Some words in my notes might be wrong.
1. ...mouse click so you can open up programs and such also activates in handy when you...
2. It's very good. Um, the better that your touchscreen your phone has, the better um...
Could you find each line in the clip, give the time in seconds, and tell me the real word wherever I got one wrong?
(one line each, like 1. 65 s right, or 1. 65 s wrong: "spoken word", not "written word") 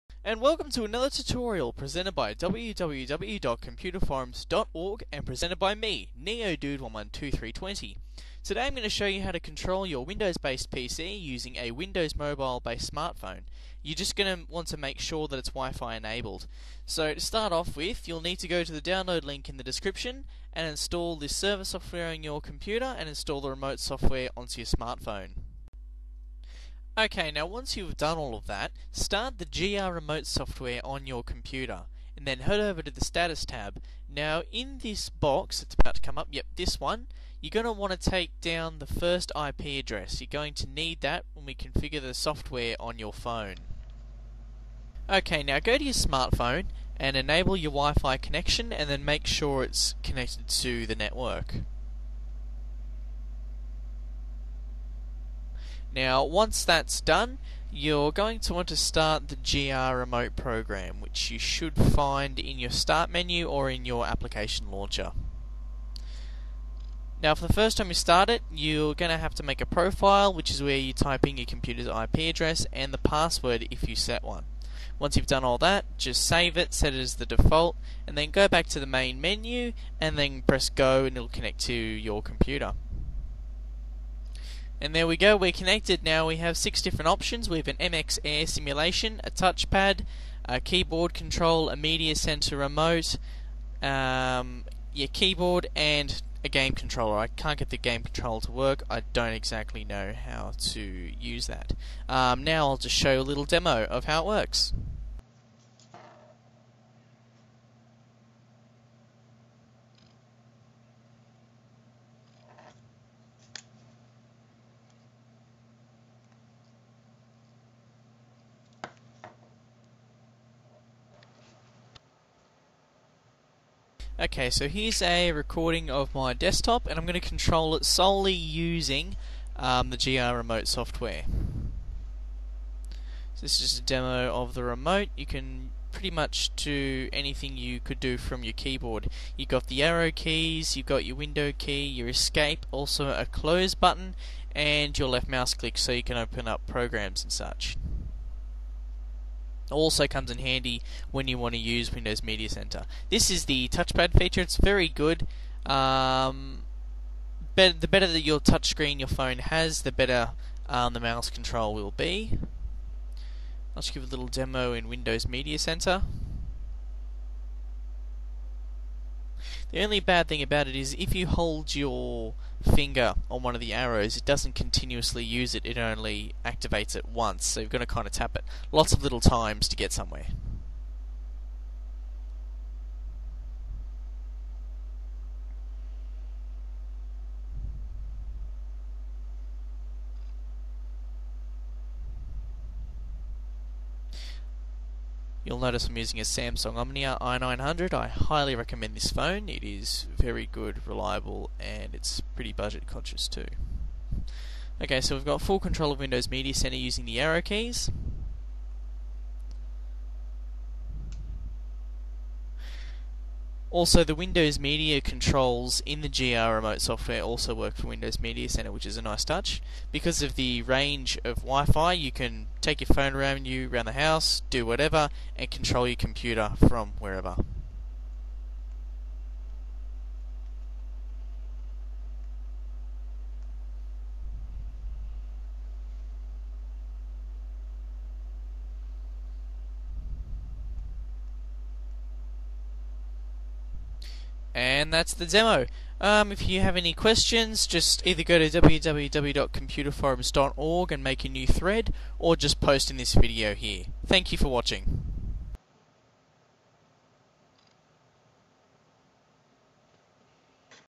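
1. 145 s wrong: "comes", not "activates"
2. 154 s right.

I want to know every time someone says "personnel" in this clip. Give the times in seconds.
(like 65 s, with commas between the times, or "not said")
not said.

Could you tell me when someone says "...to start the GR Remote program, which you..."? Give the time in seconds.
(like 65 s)
58 s.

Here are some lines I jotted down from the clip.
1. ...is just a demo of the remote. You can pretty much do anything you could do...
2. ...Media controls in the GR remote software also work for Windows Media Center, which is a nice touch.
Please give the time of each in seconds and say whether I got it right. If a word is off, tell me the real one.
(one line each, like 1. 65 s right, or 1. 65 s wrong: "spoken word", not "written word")
1. 133 s right
2. 214 s right.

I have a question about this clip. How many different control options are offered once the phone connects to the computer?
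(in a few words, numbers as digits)
6.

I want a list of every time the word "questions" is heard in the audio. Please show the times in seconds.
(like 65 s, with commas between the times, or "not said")
246 s.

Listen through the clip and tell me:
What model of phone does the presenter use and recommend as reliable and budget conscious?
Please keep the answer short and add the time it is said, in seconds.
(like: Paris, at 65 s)
Samsung Omnia i900, at 196 s.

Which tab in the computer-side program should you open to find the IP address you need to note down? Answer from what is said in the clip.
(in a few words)
Status.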